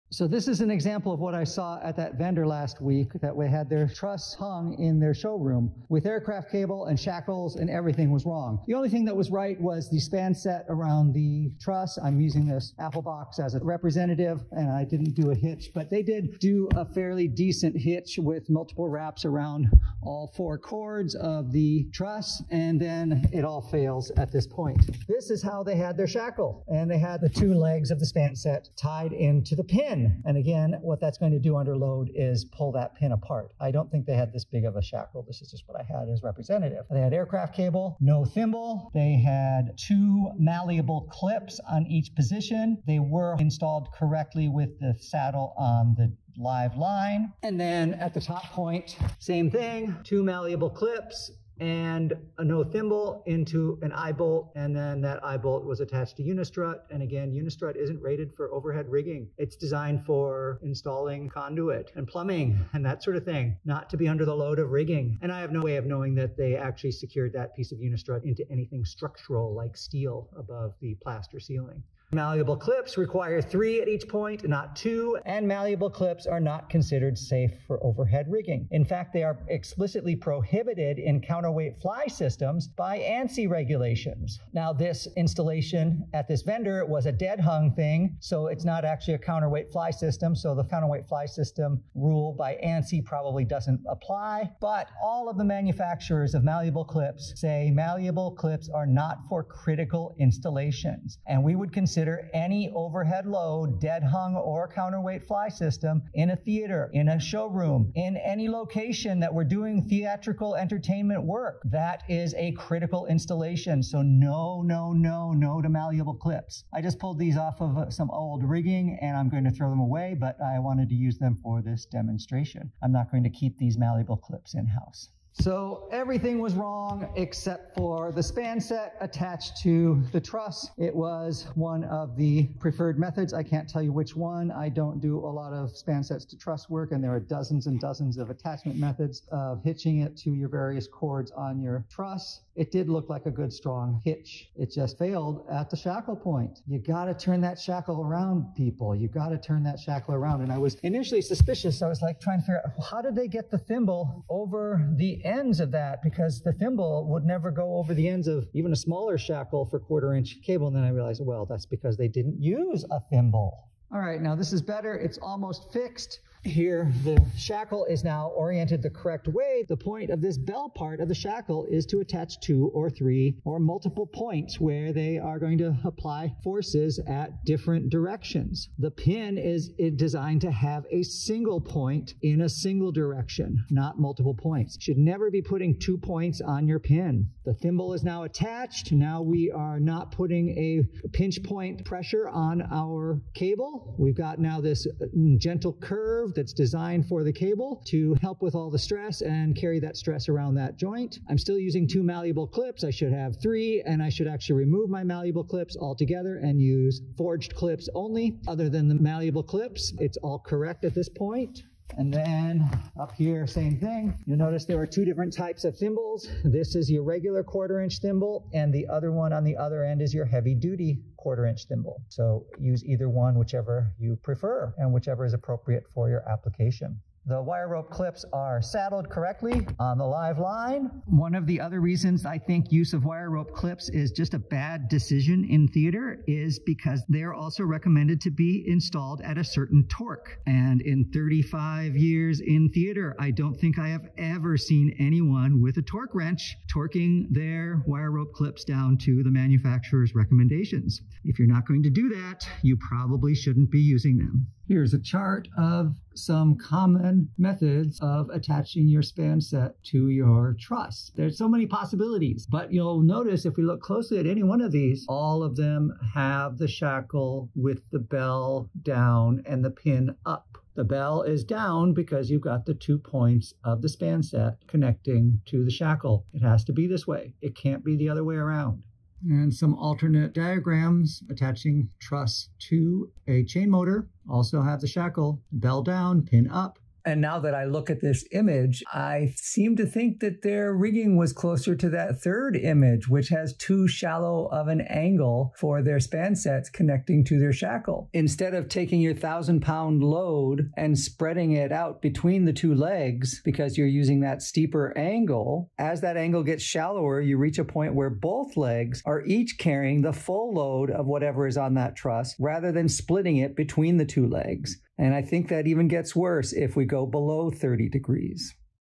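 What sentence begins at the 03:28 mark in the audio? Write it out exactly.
Other than the malleable clips, it's all correct at this point.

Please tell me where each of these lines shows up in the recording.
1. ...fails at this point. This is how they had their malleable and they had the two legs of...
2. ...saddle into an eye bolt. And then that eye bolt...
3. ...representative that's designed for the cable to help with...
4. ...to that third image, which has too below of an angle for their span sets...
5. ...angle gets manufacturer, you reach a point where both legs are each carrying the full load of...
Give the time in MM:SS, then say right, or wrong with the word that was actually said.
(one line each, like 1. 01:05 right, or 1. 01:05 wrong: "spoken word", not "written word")
1. 00:23 wrong: "shackle", not "malleable"
2. 00:52 wrong: "thimble", not "saddle"
3. 03:16 wrong: "curve", not "representative"
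4. 04:51 wrong: "shallow", not "below"
5. 05:06 wrong: "shallower", not "manufacturer".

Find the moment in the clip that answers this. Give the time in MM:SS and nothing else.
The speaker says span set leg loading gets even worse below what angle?
05:17.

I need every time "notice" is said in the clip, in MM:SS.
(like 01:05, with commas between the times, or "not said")
03:34, 04:23.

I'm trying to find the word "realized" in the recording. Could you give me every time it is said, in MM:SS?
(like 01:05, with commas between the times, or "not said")
02:40.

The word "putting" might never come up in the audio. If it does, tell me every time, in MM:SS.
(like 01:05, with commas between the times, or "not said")
03:05, 03:10.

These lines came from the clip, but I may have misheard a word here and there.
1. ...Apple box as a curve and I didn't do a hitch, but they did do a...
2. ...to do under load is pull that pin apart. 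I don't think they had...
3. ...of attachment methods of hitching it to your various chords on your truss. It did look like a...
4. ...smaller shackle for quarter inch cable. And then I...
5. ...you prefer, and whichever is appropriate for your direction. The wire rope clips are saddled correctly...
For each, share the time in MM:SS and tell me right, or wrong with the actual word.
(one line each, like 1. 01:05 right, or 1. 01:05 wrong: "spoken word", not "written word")
1. 00:12 wrong: "representative", not "curve"
2. 00:31 right
3. 02:18 right
4. 02:38 right
5. 03:43 wrong: "application", not "direction".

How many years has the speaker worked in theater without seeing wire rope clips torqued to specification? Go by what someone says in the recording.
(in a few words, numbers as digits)
35.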